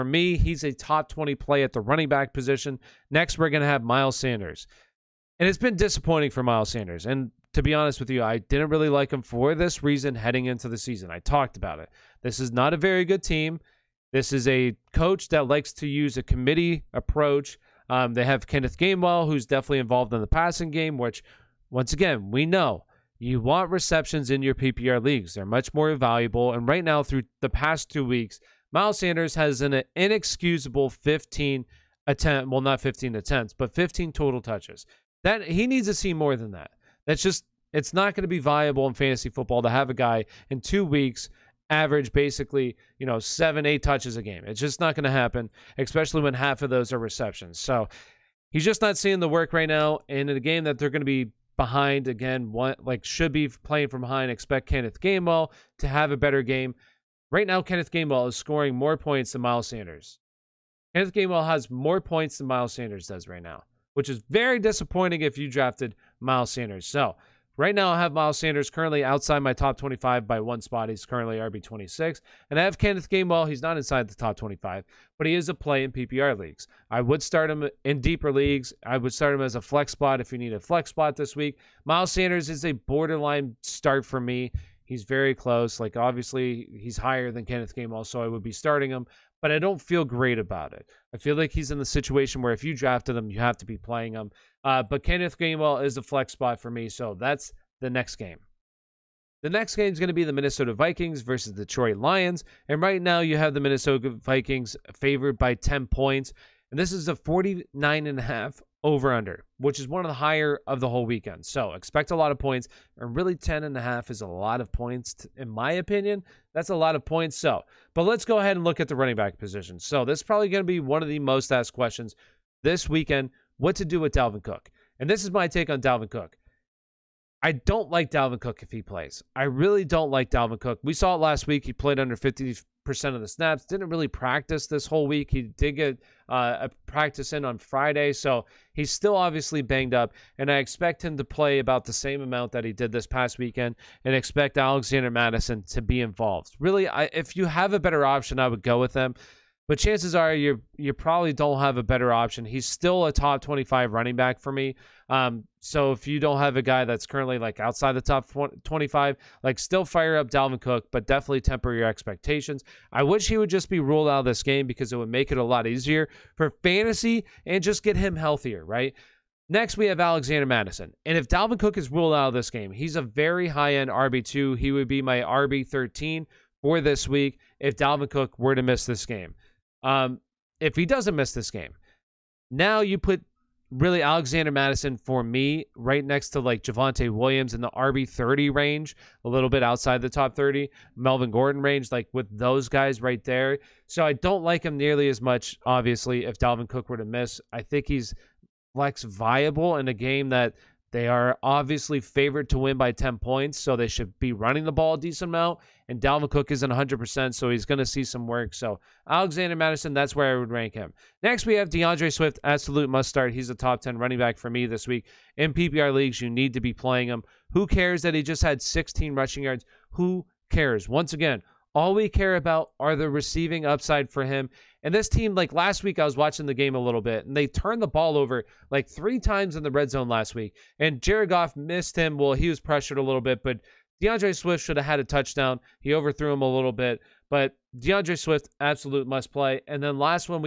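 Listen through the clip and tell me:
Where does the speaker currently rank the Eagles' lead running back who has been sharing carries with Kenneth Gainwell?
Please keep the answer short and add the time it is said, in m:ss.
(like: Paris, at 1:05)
RB26, at 1:11.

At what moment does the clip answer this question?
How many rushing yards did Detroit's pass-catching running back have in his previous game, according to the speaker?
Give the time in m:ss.
3:38.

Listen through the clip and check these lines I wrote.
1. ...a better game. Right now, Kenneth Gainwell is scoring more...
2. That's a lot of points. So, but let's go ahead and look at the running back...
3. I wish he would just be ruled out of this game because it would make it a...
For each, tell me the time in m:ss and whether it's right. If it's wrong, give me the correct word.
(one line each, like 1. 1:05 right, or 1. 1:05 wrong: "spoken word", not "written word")
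1. 0:56 right
2. 1:56 right
3. 2:42 right.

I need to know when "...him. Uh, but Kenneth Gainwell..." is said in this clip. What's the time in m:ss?
1:34.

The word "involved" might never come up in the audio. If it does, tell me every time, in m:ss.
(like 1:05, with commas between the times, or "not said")
0:19, 2:25.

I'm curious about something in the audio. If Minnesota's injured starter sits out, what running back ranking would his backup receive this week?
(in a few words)
RB13.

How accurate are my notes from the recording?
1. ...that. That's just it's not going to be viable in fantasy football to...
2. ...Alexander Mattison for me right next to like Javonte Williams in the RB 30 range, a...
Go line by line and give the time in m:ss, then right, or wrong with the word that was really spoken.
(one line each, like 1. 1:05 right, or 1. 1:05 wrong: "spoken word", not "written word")
1. 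0:36 right
2. 3:04 right.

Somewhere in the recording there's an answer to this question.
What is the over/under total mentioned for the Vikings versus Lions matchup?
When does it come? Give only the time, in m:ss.
1:47.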